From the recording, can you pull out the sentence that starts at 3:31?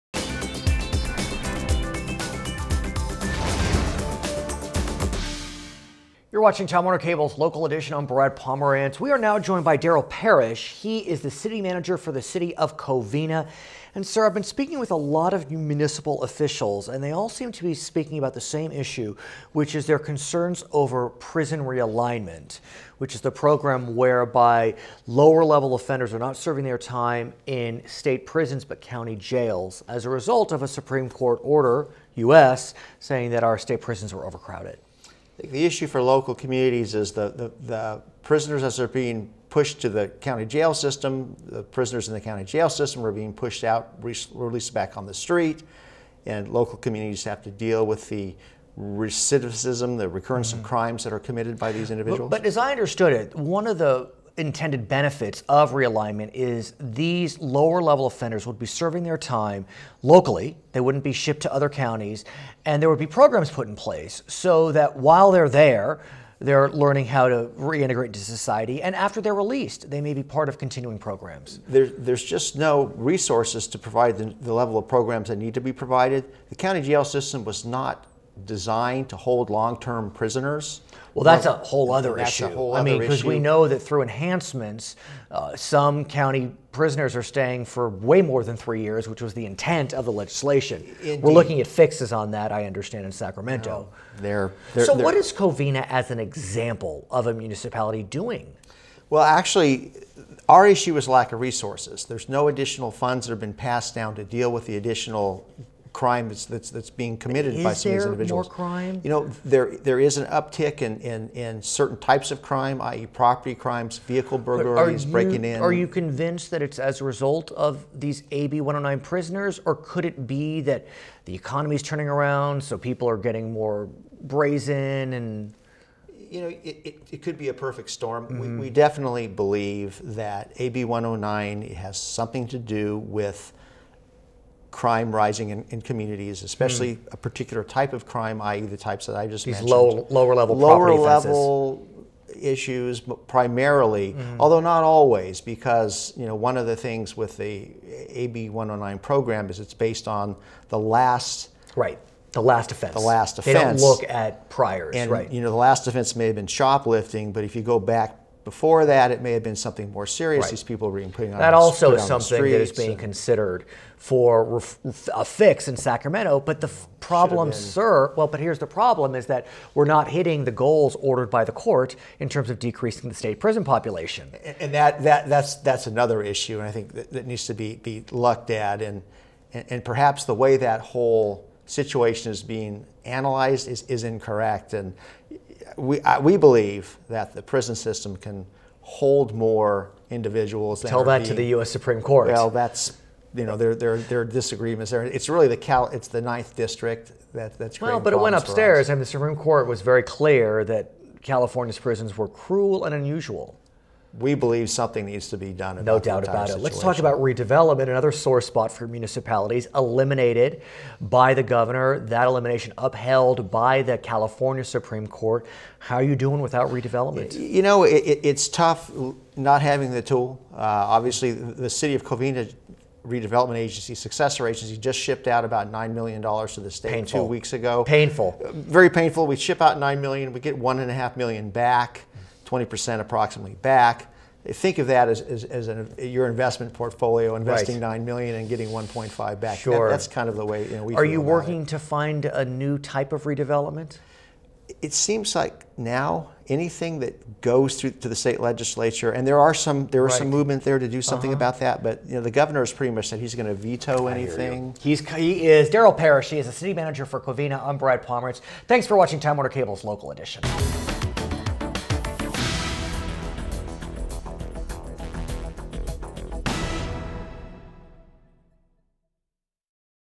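That elimination upheld by the California Supreme Court.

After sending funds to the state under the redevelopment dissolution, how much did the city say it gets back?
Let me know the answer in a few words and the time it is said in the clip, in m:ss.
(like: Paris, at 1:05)
1.5 million, at 3:50.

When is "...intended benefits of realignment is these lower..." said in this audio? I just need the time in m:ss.
0:54.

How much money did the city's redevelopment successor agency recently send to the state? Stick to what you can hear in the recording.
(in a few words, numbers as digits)
9 million dollars.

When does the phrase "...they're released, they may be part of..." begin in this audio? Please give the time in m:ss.
1:09.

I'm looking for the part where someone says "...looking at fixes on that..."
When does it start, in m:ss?
1:31.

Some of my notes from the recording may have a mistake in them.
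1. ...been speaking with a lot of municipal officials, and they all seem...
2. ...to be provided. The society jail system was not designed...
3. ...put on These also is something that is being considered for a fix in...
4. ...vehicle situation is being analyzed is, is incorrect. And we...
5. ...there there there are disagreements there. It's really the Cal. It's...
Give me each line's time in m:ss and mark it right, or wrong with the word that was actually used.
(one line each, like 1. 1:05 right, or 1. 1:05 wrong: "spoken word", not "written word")
1. 0:14 right
2. 1:15 wrong: "county", not "society"
3. 2:41 wrong: "That", not "These"
4. 3:00 wrong: "whole", not "vehicle"
5. 3:13 right.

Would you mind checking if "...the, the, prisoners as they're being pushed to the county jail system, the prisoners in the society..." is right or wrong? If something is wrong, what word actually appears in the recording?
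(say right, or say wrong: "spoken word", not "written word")
wrong: "county", not "society".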